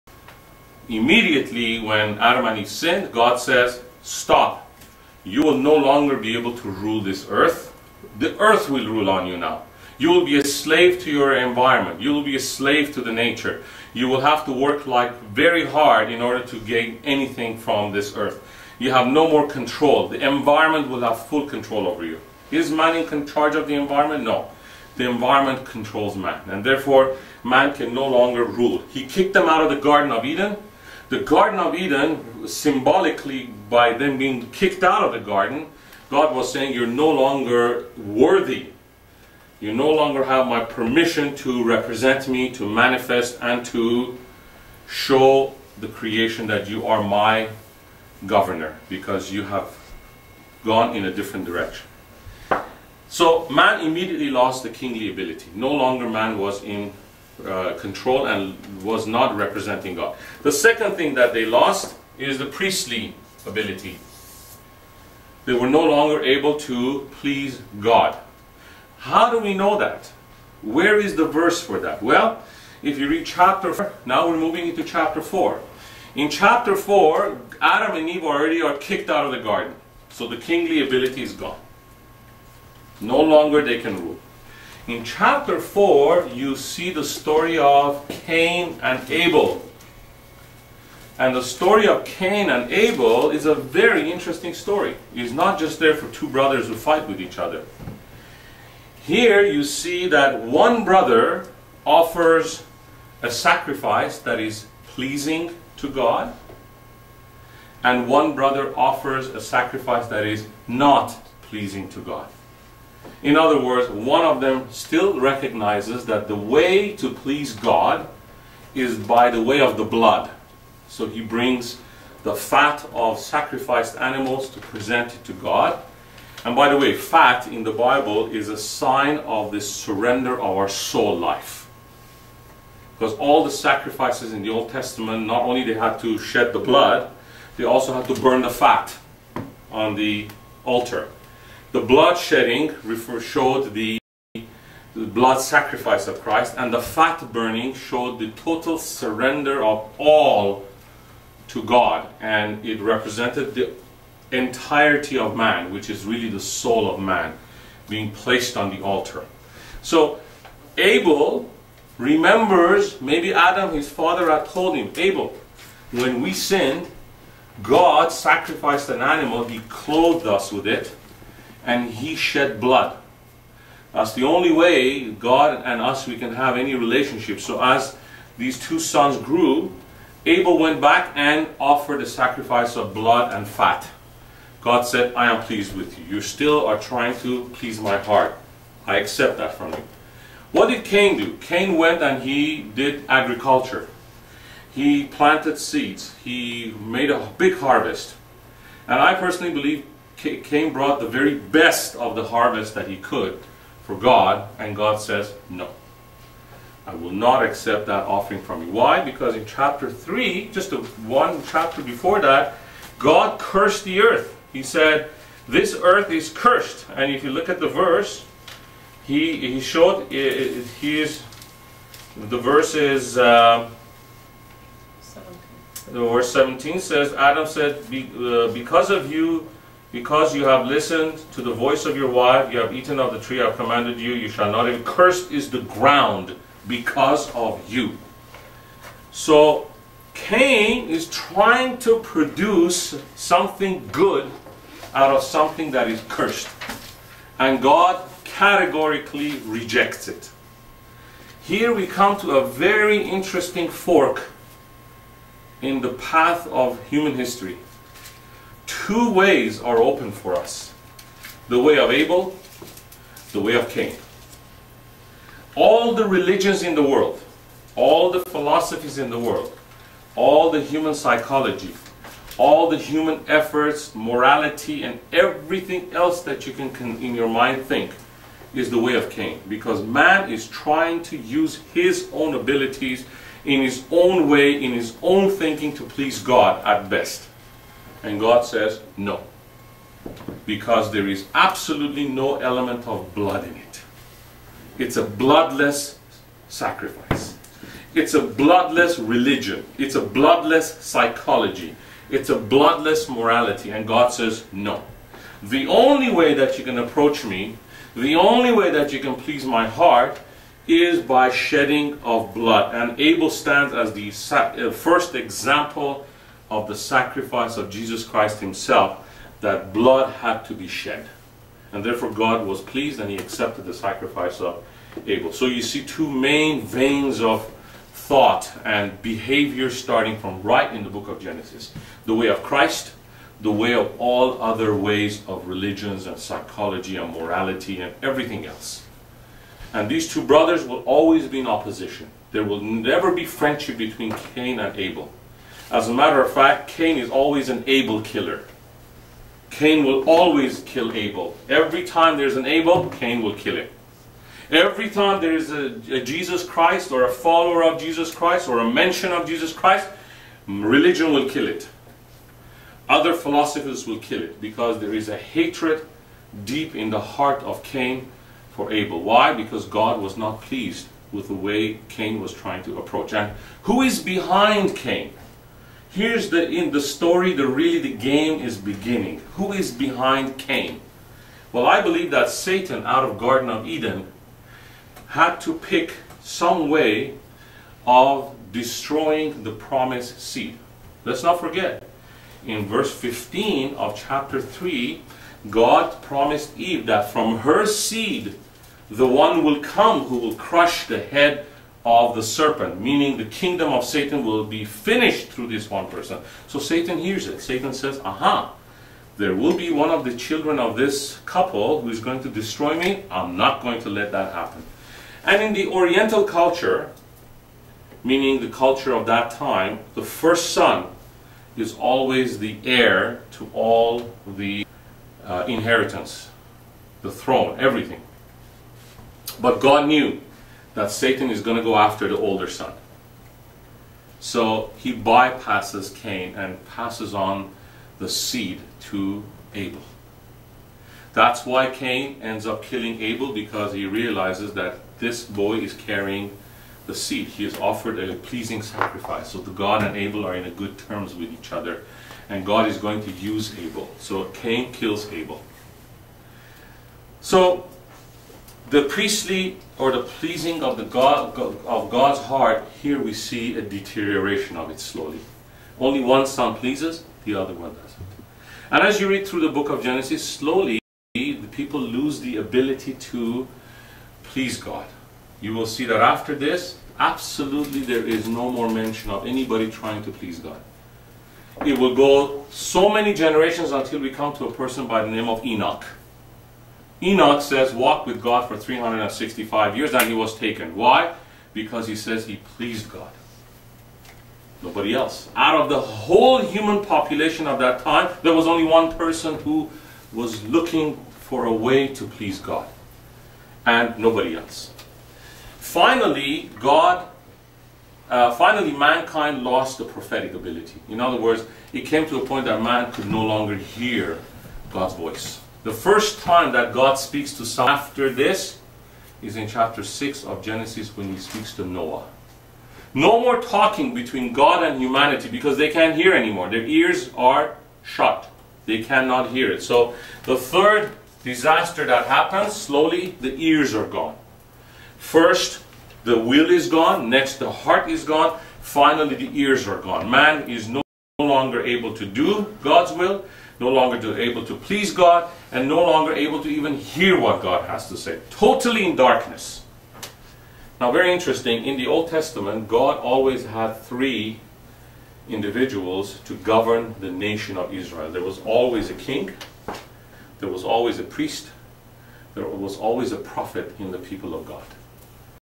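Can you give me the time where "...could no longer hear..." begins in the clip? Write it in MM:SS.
08:32.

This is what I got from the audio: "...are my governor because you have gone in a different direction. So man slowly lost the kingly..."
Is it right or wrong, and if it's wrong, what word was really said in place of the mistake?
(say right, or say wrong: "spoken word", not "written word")
wrong: "immediately", not "slowly".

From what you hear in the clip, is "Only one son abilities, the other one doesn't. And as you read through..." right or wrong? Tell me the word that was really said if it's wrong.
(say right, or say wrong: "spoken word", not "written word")
wrong: "pleases", not "abilities".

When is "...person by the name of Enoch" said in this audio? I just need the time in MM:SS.
08:04.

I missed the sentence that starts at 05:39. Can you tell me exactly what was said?
And these two brothers will always be in opposition.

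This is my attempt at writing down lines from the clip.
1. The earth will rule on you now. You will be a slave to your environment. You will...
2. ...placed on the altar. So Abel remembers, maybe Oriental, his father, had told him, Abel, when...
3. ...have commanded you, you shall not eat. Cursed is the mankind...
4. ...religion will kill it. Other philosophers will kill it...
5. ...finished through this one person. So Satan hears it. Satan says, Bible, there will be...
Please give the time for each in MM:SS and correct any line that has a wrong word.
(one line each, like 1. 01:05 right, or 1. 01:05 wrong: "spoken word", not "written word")
1. 00:08 right
2. 02:38 wrong: "Adam", not "Oriental"
3. 03:53 wrong: "ground", not "mankind"
4. 06:00 right
5. 06:44 wrong: "Aha", not "Bible".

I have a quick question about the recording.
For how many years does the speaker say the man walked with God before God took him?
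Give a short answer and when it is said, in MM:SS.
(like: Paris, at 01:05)
365, at 08:08.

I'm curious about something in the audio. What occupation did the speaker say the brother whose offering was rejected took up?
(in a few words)
agriculture.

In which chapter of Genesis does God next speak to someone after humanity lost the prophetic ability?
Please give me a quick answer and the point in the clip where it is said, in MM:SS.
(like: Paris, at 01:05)
chapter 6, at 08:39.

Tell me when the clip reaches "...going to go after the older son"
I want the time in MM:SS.
07:11.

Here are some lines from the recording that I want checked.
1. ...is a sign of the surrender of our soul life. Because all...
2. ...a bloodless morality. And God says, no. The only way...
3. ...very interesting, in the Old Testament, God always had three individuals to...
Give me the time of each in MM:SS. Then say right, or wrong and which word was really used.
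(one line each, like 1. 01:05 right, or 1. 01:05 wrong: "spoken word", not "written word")
1. 02:08 right
2. 05:02 right
3. 09:10 right.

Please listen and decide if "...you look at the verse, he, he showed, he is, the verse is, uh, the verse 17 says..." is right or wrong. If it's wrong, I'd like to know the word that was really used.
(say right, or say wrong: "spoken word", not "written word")
right.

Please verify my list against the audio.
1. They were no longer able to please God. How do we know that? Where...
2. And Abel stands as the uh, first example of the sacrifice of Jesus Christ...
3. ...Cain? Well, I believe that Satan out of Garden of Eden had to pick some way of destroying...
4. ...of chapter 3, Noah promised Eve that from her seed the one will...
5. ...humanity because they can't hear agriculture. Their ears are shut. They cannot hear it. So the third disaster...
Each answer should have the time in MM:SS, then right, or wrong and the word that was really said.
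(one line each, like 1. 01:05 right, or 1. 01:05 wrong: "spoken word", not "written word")
1. 01:05 right
2. 05:12 right
3. 06:20 right
4. 06:33 wrong: "God", not "Noah"
5. 08:44 wrong: "anymore", not "agriculture".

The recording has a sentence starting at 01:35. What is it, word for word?
It's not just there for two brothers who fight with each other.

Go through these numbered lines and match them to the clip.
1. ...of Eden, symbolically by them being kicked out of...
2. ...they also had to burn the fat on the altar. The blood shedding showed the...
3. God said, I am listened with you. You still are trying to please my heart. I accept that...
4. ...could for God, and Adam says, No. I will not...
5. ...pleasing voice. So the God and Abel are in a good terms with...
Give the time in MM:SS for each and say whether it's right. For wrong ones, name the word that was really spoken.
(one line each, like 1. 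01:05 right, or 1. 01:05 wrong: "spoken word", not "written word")
1. 00:31 right
2. 02:17 right
3. 03:04 wrong: "pleased", not "listened"
4. 03:22 wrong: "God", not "Adam"
5. 07:28 wrong: "sacrifice", not "voice".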